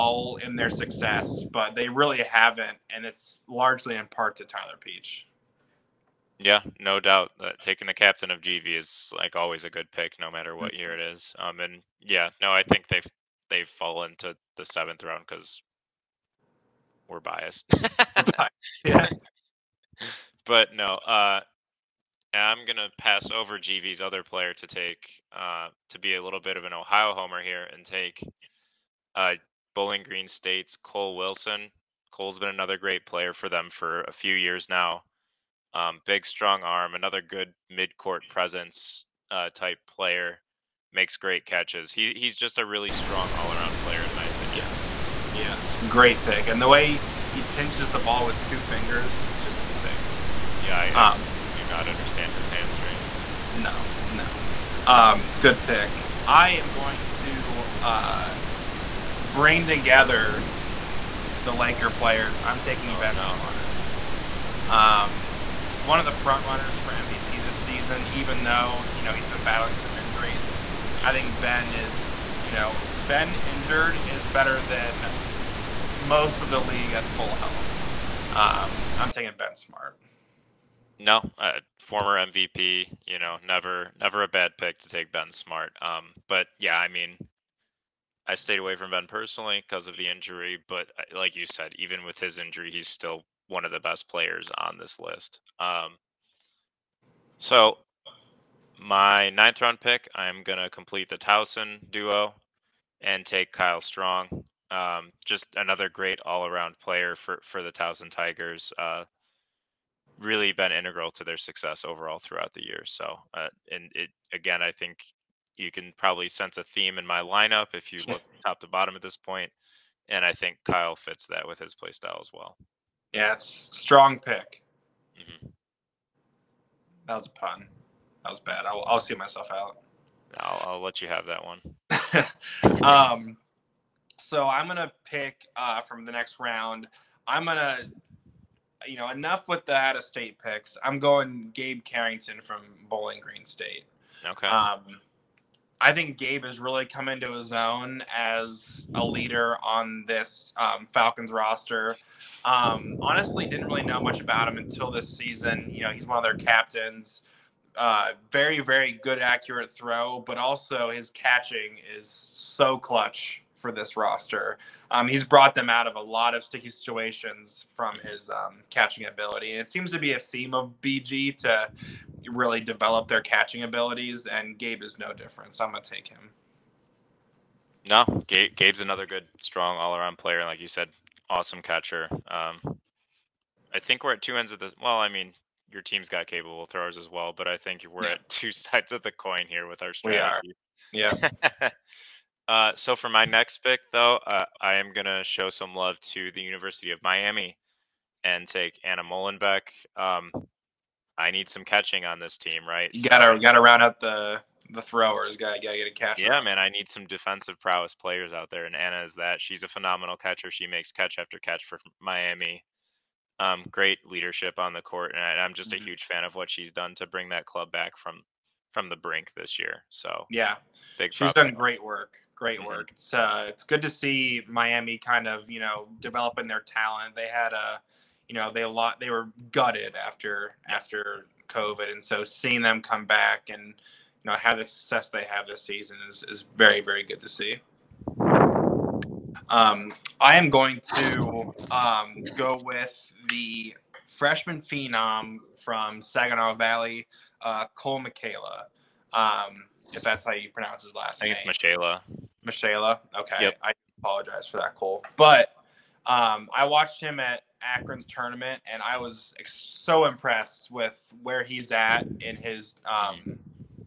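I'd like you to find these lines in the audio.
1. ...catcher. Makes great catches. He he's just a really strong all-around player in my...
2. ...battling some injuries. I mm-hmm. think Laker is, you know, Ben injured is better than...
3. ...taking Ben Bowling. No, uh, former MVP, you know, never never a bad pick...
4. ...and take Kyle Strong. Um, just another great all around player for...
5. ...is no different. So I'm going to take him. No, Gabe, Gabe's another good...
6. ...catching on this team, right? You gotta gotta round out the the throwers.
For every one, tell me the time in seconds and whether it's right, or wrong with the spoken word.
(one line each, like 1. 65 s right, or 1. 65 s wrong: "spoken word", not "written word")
1. 39 s wrong: "player", not "catcher"
2. 69 s wrong: "Ben", not "Laker"
3. 79 s wrong: "Smart", not "Bowling"
4. 103 s right
5. 174 s right
6. 201 s right.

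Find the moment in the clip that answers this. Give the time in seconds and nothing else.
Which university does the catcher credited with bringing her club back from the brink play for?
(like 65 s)
196 s.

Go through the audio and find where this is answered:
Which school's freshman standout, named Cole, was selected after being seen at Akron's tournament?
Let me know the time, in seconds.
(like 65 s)
246 s.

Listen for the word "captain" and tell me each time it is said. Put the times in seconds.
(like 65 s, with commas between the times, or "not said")
7 s, 156 s.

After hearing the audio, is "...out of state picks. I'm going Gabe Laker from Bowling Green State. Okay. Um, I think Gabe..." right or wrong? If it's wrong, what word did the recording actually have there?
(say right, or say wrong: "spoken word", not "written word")
wrong: "Carrington", not "Laker".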